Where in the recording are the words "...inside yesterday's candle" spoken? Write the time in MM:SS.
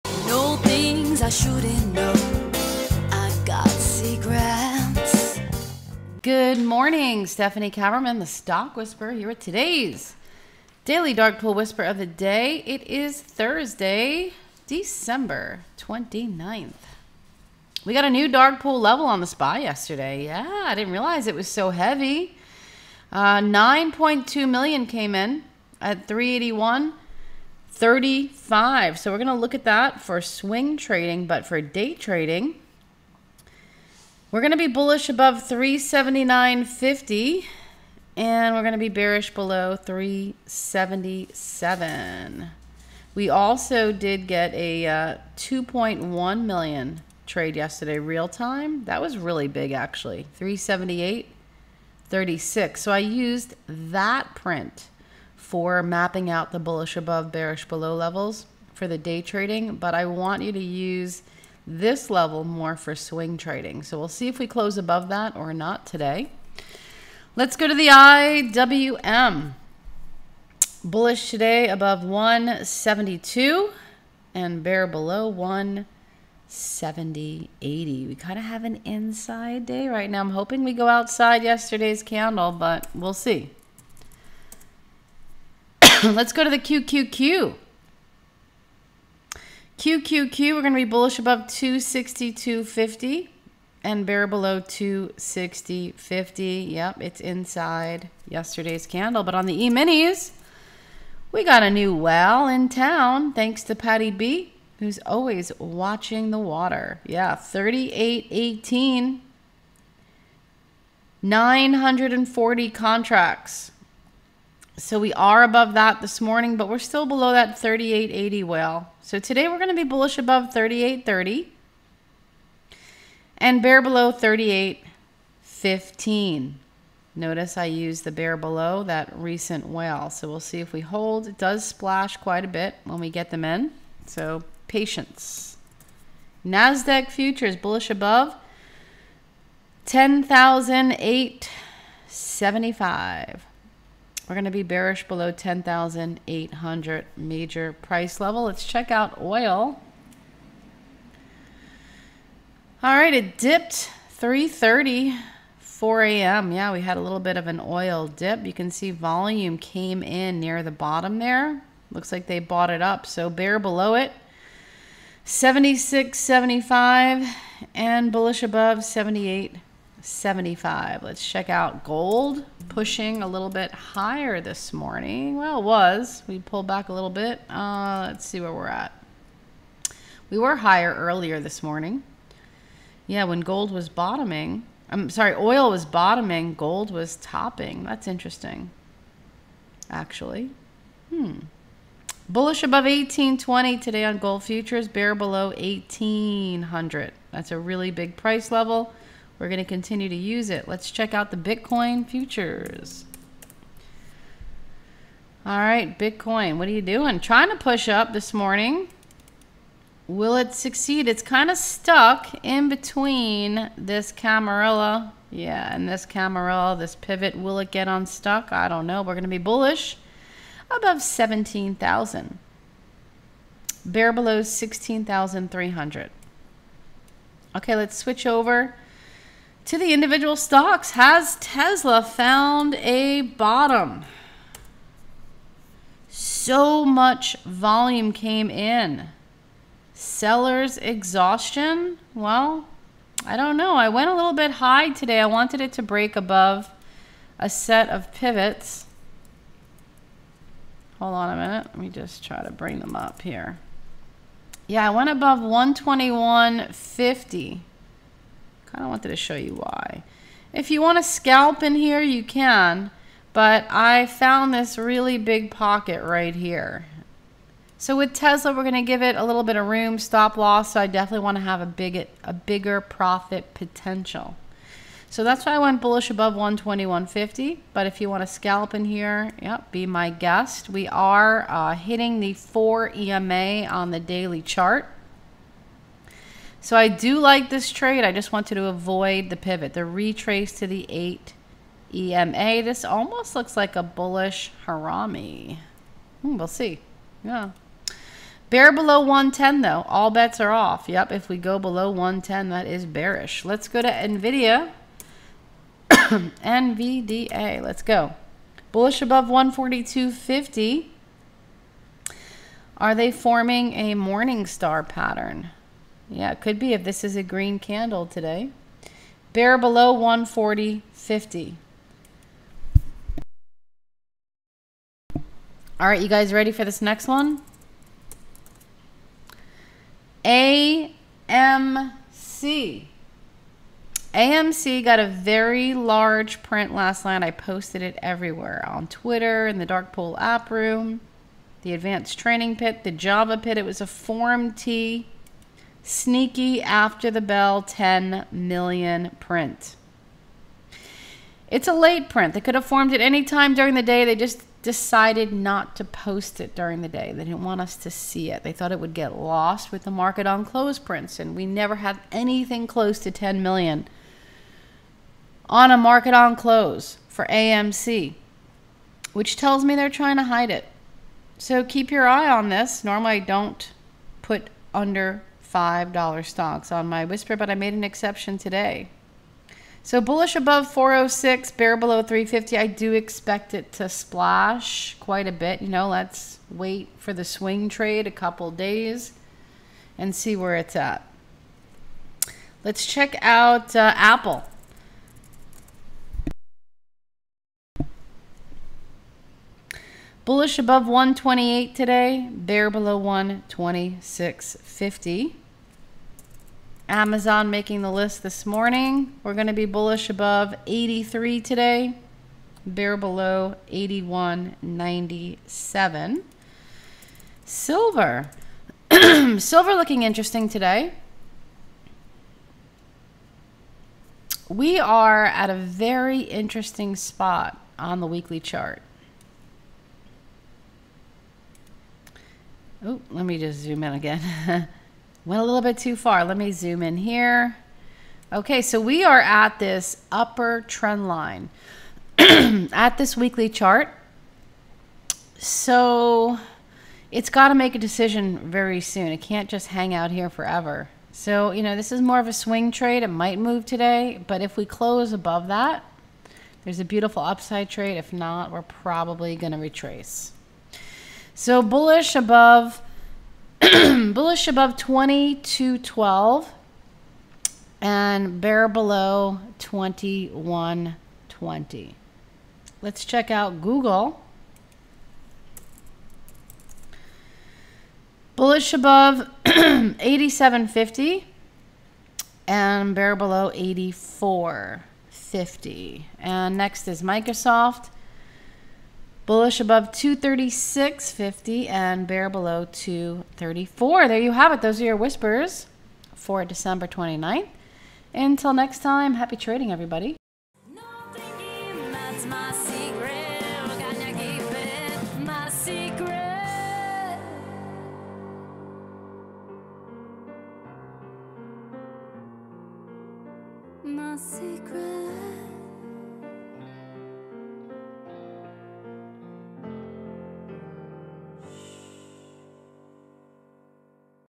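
01:37.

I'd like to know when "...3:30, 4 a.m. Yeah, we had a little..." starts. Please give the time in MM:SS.
02:34.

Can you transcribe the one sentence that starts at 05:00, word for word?
Yep, if we go below 110, that is bearish.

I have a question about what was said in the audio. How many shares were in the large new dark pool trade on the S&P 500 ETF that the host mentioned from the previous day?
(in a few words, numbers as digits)
9.2 million.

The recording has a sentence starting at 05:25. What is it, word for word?
All right, you guys ready for this next one?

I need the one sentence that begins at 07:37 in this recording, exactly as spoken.
If not, we're probably going to retrace.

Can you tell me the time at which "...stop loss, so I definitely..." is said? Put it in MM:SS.
04:29.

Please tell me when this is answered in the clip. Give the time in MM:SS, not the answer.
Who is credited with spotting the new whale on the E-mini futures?
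01:43.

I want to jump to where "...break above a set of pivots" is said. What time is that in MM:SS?
04:05.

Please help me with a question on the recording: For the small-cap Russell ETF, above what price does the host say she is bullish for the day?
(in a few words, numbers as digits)
172.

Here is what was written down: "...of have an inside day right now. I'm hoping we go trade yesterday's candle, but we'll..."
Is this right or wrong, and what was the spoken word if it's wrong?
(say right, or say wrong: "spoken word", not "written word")
wrong: "outside", not "trade".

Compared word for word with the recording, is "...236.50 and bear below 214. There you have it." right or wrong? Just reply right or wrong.
wrong.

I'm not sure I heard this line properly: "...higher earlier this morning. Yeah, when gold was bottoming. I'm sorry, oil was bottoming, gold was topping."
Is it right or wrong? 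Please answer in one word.
right.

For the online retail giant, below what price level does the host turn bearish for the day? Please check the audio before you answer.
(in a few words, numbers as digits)
81.97.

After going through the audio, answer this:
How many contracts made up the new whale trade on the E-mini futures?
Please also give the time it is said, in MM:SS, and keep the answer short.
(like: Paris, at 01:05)
940, at 01:51.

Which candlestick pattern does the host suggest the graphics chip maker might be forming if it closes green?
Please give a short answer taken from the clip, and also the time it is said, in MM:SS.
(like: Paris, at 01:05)
Morningstar, at 05:13.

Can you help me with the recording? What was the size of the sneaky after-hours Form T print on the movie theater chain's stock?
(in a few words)
10 million.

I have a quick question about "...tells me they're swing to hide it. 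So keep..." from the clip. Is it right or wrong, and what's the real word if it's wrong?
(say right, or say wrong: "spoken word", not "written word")
wrong: "trying", not "swing".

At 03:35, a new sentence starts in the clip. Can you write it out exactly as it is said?
Yeah, and this Camarilla, this pivot.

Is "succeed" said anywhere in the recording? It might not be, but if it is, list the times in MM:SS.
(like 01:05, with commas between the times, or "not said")
03:30.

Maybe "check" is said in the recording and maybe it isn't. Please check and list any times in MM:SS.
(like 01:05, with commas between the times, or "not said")
02:28, 02:51, 03:20, 06:32, 07:53.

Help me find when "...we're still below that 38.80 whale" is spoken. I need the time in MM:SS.
01:56.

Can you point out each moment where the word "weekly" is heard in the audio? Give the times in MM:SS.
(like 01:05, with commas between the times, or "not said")
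07:08, 07:23.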